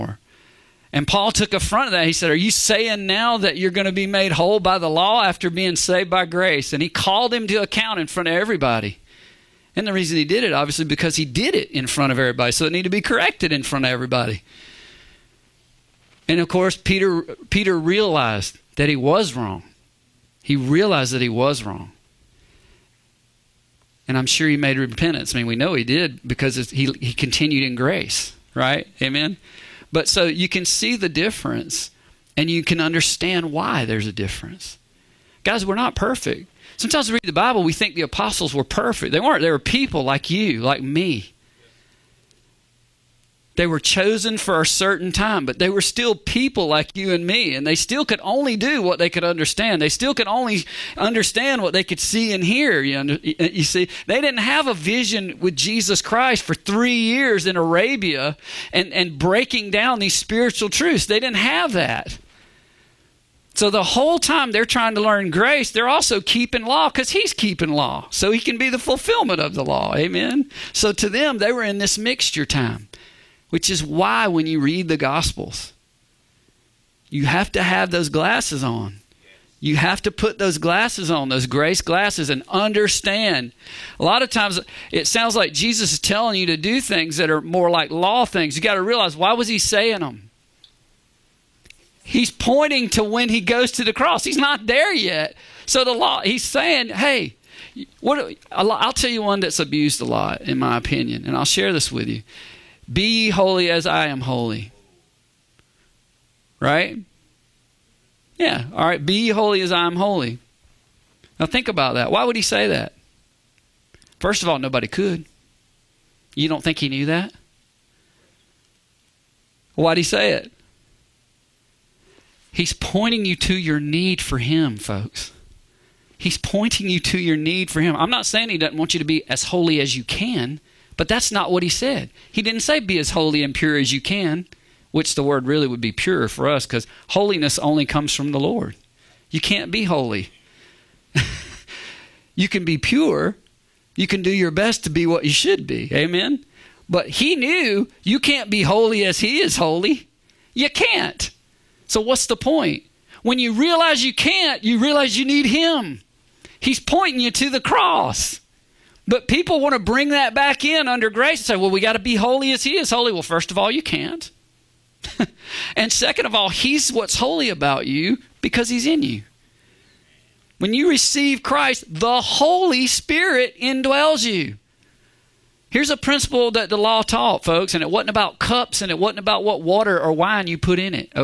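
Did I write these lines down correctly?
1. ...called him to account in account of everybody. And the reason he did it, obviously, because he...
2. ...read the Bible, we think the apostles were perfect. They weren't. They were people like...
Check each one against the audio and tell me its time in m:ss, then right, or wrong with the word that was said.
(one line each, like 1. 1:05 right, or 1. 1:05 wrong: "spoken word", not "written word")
1. 0:06 wrong: "front", not "account"
2. 0:37 right.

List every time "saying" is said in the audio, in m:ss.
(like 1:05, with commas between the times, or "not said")
0:02, 1:29, 1:36, 2:08.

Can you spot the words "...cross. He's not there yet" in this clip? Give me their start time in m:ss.
1:33.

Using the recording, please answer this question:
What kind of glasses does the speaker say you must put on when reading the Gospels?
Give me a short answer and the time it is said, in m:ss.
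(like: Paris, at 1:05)
Grace glasses, at 1:21.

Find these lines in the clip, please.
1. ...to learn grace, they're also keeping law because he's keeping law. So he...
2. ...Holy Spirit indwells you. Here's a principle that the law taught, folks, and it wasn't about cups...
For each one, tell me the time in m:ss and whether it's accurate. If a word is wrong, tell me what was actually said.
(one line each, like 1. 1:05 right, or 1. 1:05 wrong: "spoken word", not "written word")
1. 1:04 right
2. 2:52 right.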